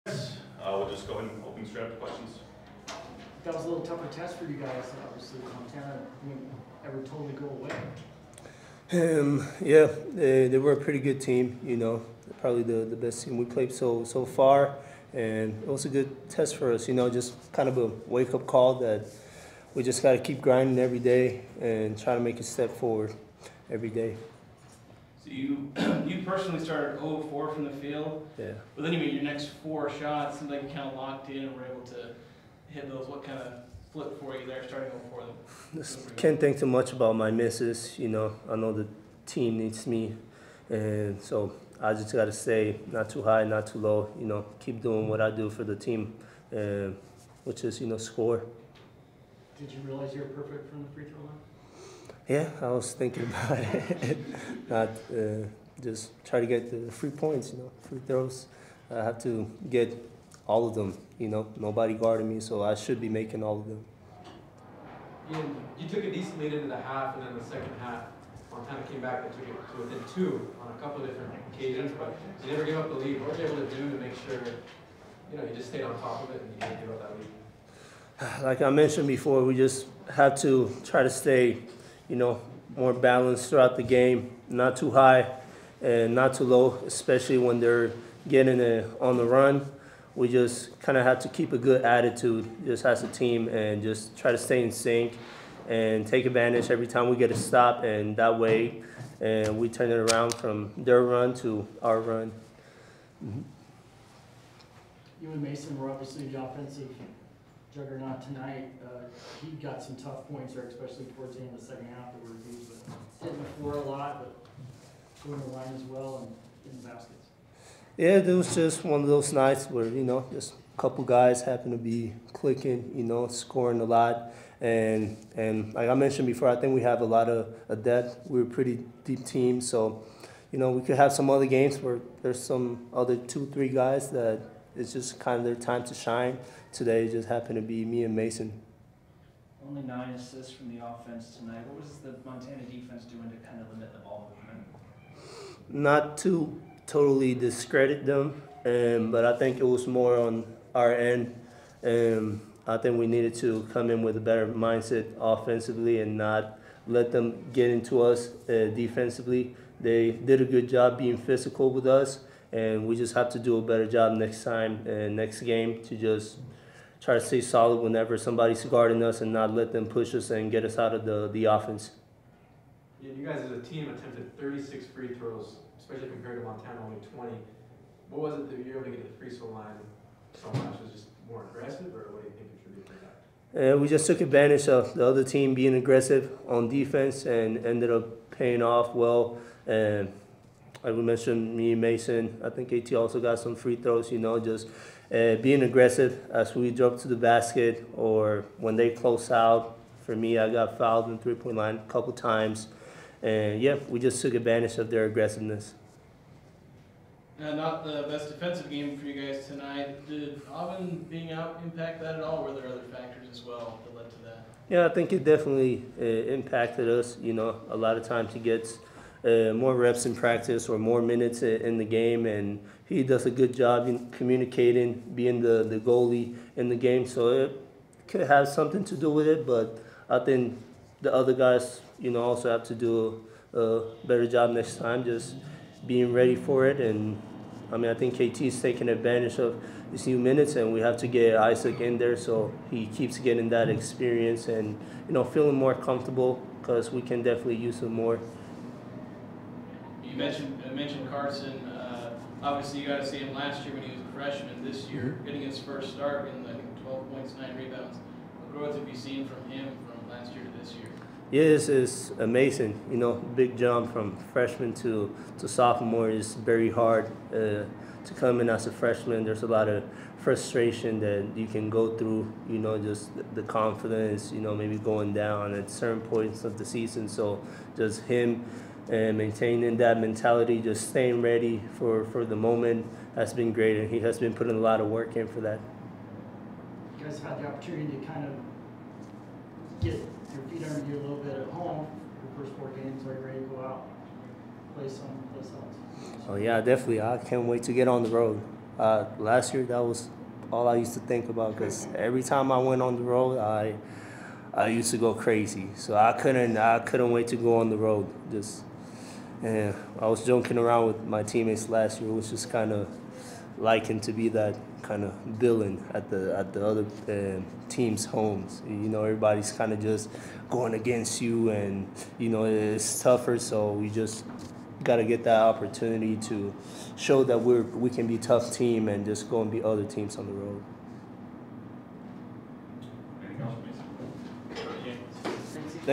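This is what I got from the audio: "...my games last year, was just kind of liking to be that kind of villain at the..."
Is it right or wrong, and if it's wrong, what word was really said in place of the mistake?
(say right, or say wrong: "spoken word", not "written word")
wrong: "teammates", not "games".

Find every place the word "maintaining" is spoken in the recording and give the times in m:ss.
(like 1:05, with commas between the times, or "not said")
4:39.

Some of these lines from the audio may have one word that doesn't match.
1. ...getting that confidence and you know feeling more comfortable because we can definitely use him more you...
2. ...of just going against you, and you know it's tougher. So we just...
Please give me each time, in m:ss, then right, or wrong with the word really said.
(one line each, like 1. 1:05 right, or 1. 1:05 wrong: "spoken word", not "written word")
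1. 4:03 wrong: "experience", not "confidence"
2. 5:19 right.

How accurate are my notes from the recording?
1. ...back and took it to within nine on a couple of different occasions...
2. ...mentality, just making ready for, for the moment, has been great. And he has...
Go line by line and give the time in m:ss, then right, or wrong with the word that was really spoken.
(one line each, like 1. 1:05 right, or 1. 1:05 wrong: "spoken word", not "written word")
1. 1:09 wrong: "two", not "nine"
2. 4:39 wrong: "staying", not "making".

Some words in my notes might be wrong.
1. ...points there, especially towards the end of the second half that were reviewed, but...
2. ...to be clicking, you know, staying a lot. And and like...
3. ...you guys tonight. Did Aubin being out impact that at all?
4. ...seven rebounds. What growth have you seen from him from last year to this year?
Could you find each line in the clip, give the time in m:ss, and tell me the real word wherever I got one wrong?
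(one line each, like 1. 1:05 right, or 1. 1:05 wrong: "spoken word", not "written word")
1. 1:50 right
2. 2:01 wrong: "scoring", not "staying"
3. 3:29 right
4. 4:17 wrong: "nine", not "seven".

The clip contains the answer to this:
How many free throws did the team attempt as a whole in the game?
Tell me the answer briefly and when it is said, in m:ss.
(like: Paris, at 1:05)
36, at 2:54.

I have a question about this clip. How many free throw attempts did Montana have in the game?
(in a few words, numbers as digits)
20.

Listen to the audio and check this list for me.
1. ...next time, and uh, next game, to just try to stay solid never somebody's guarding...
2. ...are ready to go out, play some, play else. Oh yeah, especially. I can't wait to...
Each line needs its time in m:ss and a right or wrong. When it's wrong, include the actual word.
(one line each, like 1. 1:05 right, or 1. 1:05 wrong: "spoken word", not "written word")
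1. 2:44 wrong: "whenever", not "never"
2. 4:53 wrong: "definitely", not "especially".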